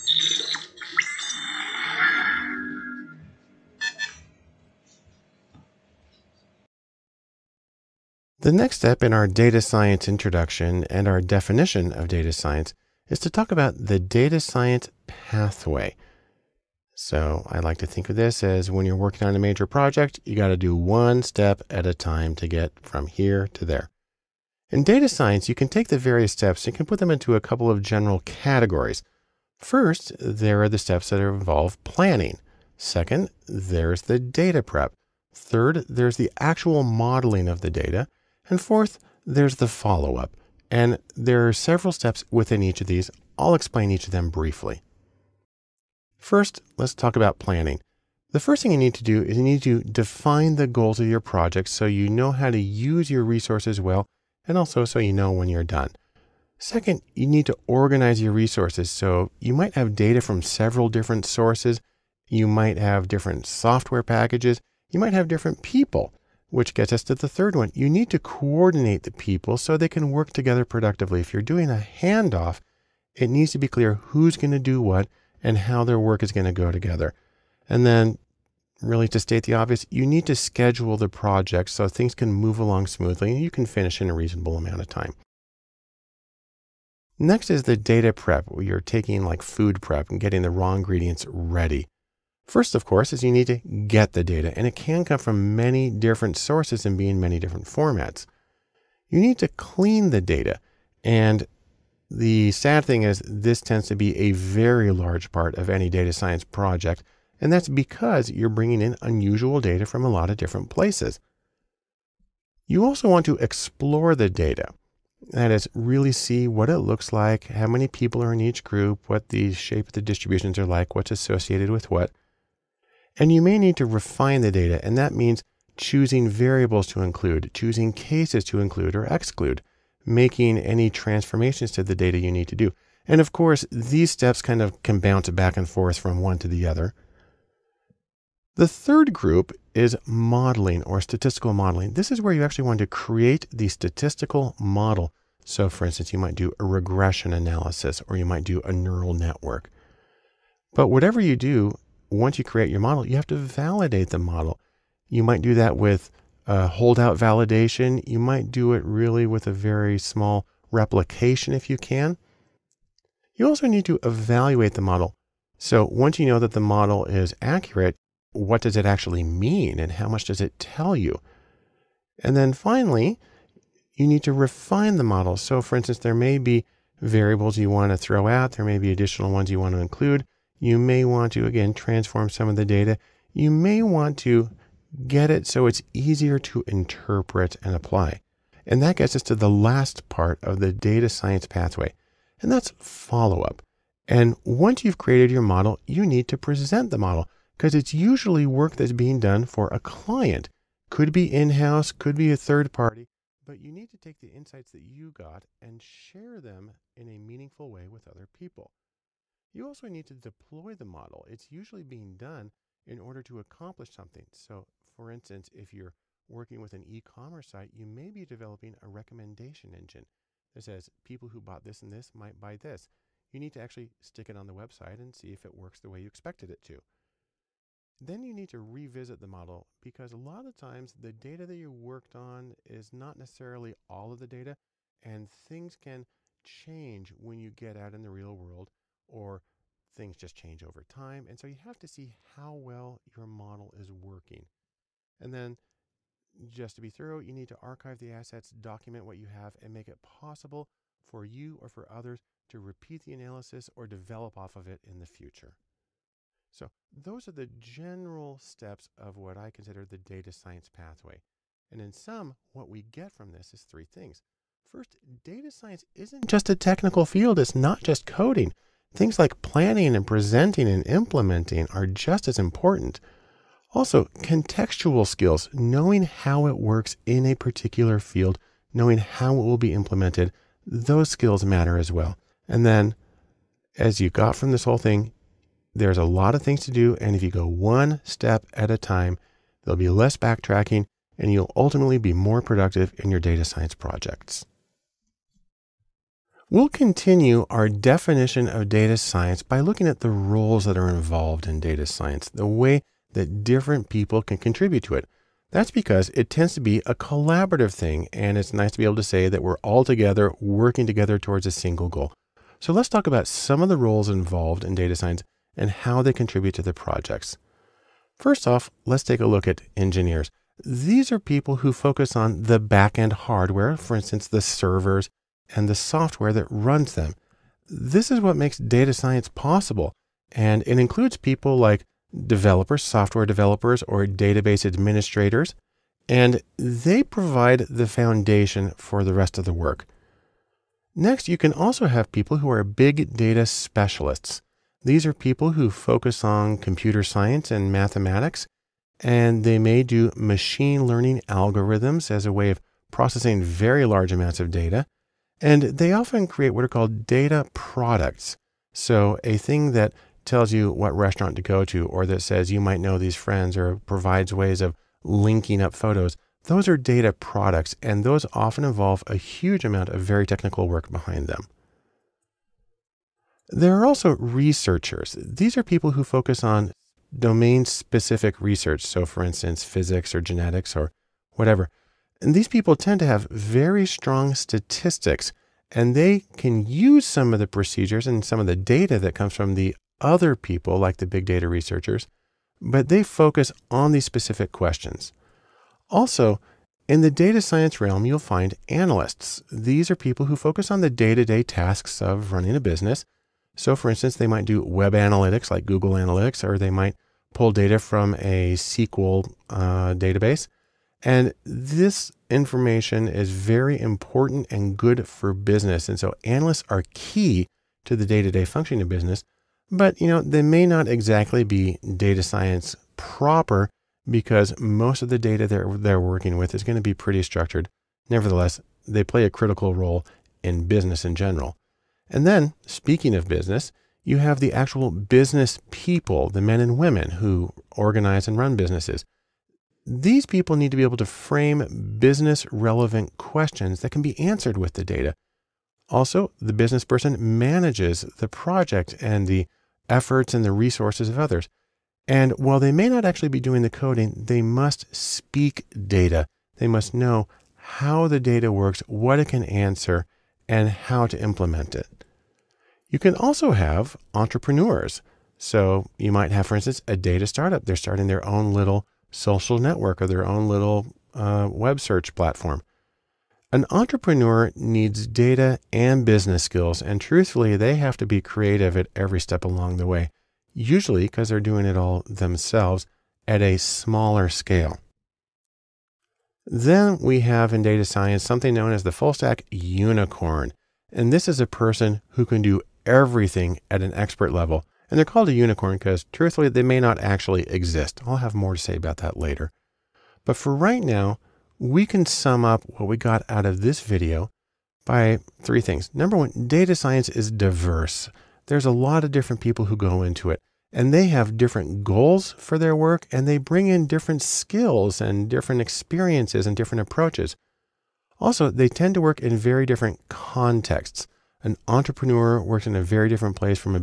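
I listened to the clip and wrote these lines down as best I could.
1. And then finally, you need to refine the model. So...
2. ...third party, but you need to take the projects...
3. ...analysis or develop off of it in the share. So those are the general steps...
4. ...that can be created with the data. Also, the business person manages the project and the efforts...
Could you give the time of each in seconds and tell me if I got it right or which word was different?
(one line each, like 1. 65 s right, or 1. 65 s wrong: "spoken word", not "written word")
1. 172 s right
2. 202 s wrong: "insights", not "projects"
3. 253 s wrong: "future", not "share"
4. 443 s wrong: "answered", not "created".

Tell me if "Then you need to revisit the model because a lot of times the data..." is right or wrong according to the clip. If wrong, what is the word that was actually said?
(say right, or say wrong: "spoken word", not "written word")
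right.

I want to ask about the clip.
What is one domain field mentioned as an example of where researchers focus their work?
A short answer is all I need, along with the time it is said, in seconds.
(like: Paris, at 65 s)
physics, at 379 s.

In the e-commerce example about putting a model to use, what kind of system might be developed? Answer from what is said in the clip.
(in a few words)
recommendation engine.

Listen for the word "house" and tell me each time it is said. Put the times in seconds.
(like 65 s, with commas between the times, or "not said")
201 s.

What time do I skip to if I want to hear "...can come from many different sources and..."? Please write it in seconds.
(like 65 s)
94 s.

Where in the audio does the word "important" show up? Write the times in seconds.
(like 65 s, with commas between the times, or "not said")
272 s, 413 s.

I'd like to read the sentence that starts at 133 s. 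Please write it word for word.
And of course, these steps kind of can bounce back and forth from one to the other.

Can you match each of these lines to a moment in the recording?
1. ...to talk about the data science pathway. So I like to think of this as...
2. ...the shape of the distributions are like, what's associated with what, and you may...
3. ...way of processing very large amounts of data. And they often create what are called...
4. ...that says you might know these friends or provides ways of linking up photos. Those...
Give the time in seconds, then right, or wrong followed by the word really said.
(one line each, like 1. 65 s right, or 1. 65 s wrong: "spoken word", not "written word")
1. 13 s right
2. 119 s right
3. 352 s right
4. 362 s right.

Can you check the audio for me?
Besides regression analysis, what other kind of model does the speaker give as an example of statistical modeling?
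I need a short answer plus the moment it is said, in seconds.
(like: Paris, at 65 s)
neural network, at 148 s.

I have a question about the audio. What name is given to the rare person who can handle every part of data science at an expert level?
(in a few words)
full stack unicorn.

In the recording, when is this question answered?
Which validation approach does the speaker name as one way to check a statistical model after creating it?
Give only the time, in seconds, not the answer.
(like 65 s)
156 s.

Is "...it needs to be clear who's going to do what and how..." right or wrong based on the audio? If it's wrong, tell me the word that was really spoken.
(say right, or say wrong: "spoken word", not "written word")
right.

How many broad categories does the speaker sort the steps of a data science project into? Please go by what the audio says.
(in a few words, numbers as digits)
4.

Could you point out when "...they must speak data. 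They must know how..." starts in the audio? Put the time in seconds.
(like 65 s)
454 s.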